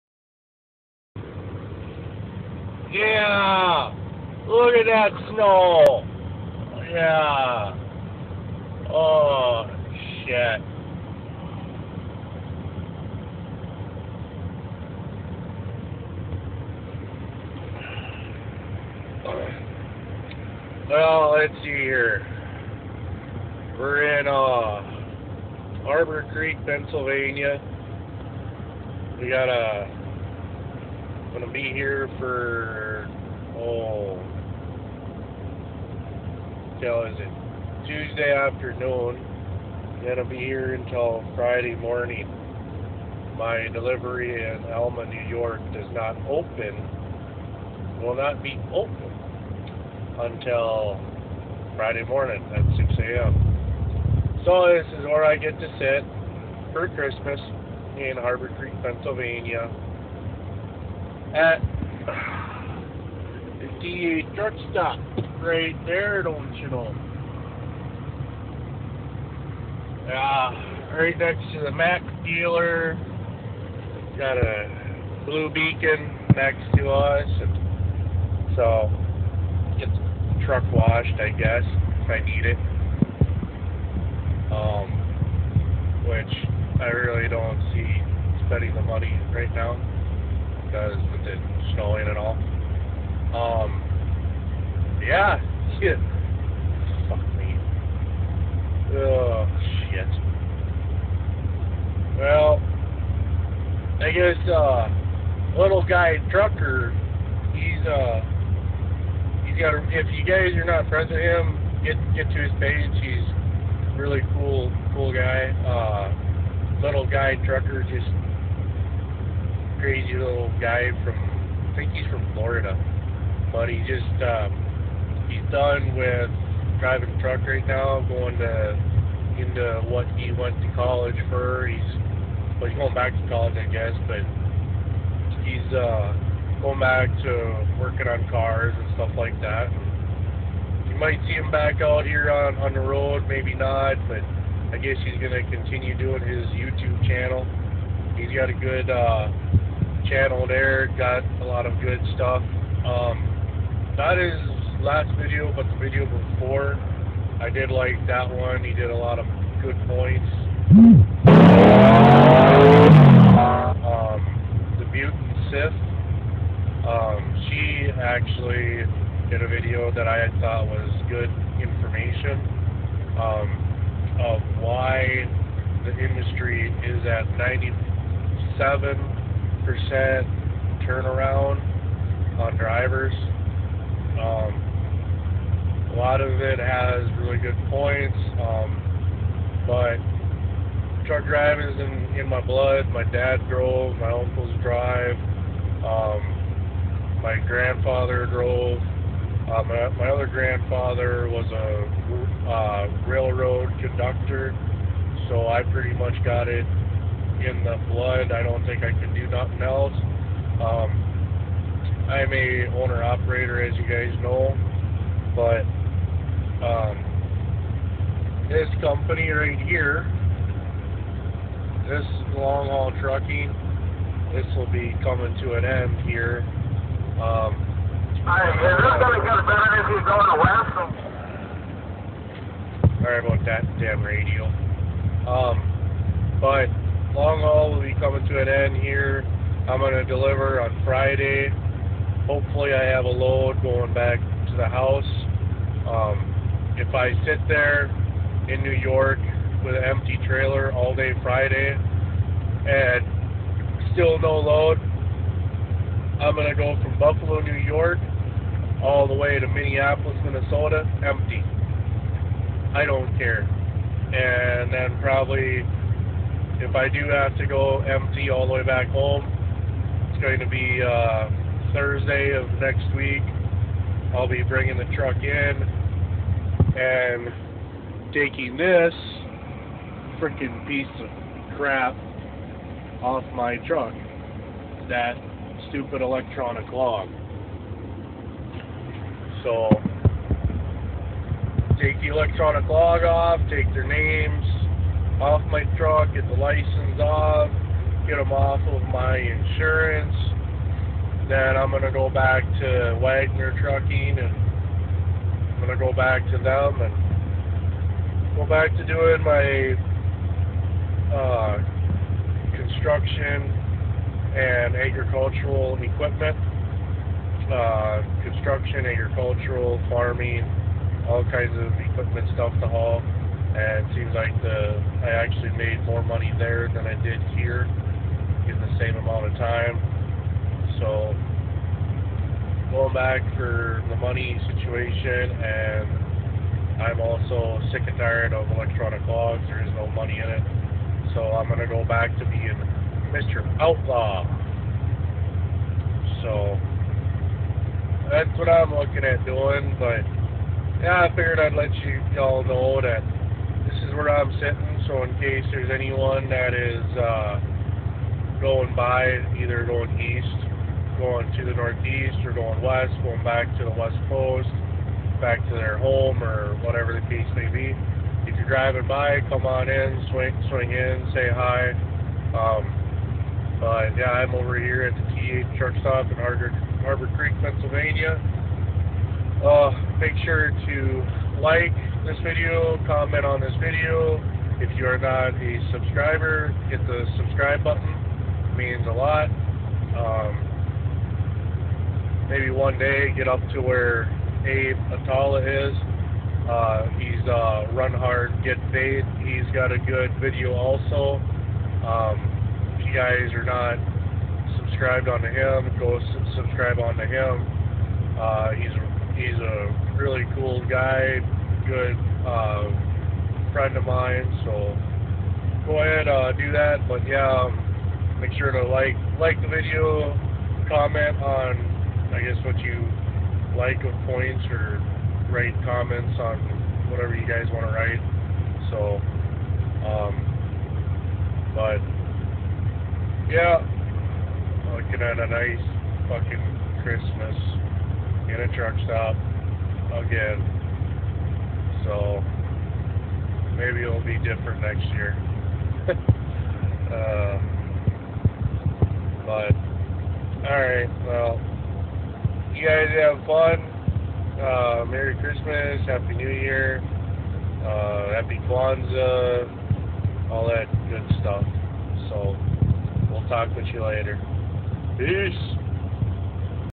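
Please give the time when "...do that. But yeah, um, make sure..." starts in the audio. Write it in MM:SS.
06:56.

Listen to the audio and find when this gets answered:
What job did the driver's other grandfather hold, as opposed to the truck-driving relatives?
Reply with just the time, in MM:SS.
03:23.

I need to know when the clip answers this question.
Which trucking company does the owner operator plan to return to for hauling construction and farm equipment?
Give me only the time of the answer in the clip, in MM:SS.
05:02.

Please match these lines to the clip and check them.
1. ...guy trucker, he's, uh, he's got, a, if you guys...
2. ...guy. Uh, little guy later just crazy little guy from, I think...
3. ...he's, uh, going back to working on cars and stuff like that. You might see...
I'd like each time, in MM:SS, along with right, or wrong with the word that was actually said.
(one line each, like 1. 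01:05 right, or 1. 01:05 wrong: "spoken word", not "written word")
1. 01:45 right
2. 01:55 wrong: "trucker", not "later"
3. 02:15 right.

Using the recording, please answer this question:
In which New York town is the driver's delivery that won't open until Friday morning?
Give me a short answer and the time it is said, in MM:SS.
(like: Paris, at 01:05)
Alma, New York, at 00:44.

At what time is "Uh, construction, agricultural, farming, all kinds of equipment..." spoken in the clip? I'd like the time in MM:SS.
05:17.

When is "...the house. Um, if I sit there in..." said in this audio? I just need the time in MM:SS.
04:04.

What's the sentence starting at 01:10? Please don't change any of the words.
Uh, right next to the Mack dealer.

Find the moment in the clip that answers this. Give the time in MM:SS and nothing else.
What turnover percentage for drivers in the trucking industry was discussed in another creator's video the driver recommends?
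02:57.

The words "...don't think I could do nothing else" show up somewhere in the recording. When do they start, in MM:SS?
03:28.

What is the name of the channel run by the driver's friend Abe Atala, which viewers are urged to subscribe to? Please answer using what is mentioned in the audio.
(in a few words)
Run Hard, Get Paid.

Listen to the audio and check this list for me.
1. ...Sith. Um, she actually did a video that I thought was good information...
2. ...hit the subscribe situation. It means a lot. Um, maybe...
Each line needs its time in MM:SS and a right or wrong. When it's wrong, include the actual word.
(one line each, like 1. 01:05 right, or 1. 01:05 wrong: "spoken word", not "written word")
1. 02:45 right
2. 06:26 wrong: "button", not "situation".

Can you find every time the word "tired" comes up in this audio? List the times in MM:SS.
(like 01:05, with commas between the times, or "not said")
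05:37.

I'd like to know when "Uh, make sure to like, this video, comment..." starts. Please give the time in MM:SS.
06:19.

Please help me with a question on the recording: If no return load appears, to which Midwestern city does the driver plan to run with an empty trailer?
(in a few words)
Minneapolis, Minnesota.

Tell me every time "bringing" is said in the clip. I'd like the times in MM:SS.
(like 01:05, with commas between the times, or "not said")
04:34.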